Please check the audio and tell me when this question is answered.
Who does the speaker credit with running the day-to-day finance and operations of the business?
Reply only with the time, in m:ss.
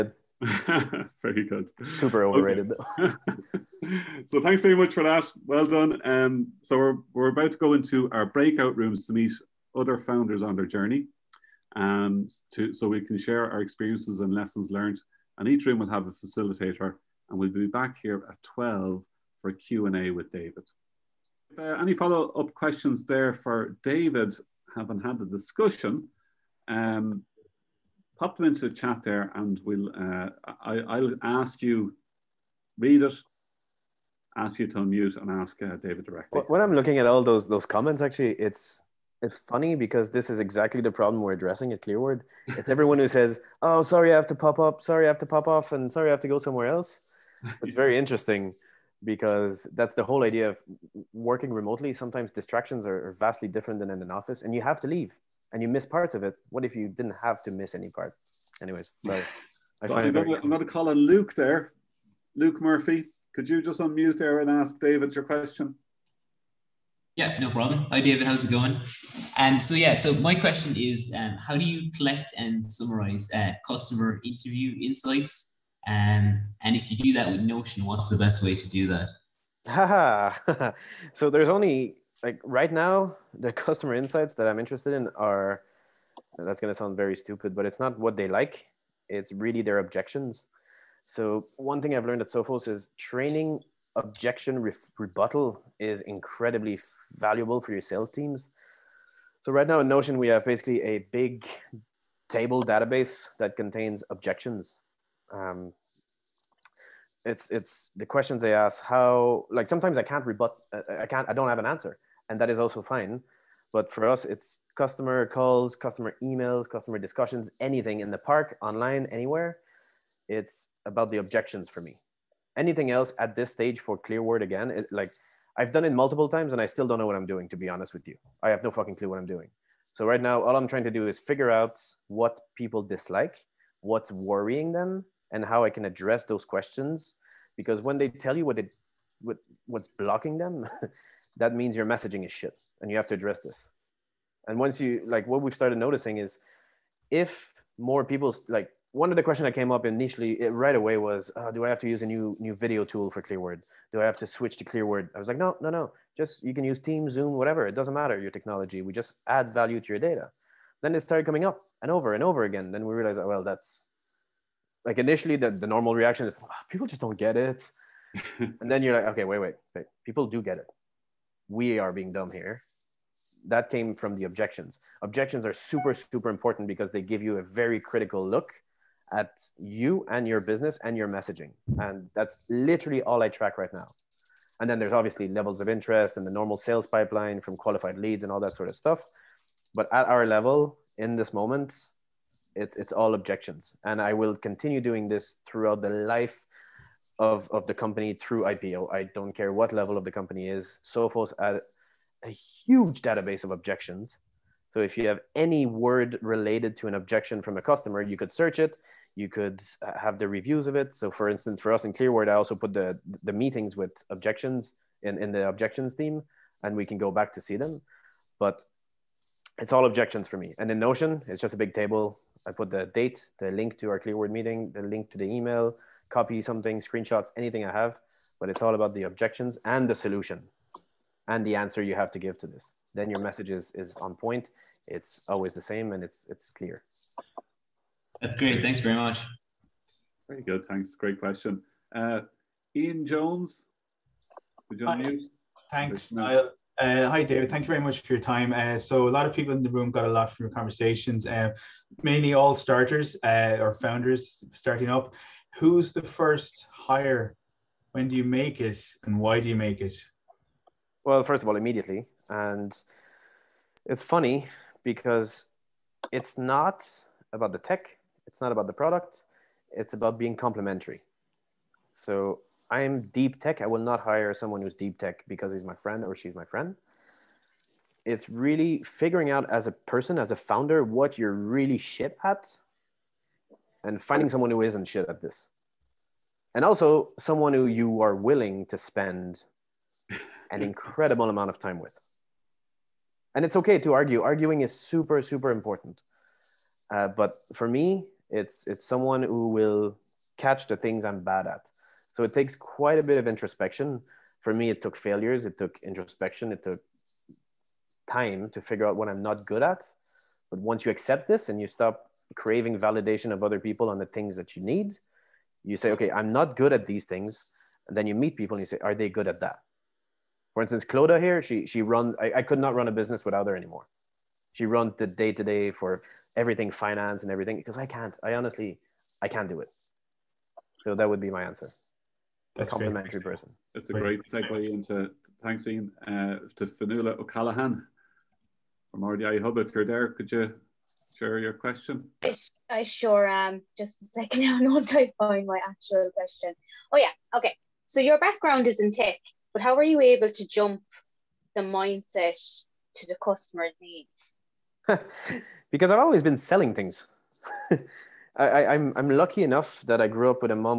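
5:20.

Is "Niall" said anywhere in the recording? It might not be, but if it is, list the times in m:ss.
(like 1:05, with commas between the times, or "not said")
4:06.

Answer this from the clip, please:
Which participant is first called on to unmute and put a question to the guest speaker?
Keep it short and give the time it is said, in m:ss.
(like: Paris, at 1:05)
Luke Murphy, at 1:02.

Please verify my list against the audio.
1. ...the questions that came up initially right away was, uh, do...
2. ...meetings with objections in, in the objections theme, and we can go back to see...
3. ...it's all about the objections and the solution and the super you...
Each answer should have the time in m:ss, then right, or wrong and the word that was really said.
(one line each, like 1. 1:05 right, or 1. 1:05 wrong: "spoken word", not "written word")
1. 2:29 right
2. 3:33 right
3. 3:48 wrong: "answer", not "super".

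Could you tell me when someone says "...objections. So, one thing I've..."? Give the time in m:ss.
1:29.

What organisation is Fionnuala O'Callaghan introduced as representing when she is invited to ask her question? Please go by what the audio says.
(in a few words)
RDI Hub.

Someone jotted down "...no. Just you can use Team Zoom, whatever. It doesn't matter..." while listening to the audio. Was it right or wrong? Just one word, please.
right.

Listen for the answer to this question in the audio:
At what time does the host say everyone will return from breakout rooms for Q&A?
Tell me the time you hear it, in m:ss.
0:18.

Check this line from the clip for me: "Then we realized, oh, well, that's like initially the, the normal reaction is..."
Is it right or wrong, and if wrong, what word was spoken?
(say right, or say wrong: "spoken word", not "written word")
right.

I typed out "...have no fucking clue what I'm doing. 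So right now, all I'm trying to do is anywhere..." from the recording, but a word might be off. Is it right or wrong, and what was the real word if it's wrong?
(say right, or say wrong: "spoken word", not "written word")
wrong: "figure", not "anywhere".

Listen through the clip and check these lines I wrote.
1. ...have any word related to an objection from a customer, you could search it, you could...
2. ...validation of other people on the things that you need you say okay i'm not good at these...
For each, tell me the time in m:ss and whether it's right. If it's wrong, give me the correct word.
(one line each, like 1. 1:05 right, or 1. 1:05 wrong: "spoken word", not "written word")
1. 3:25 right
2. 5:12 right.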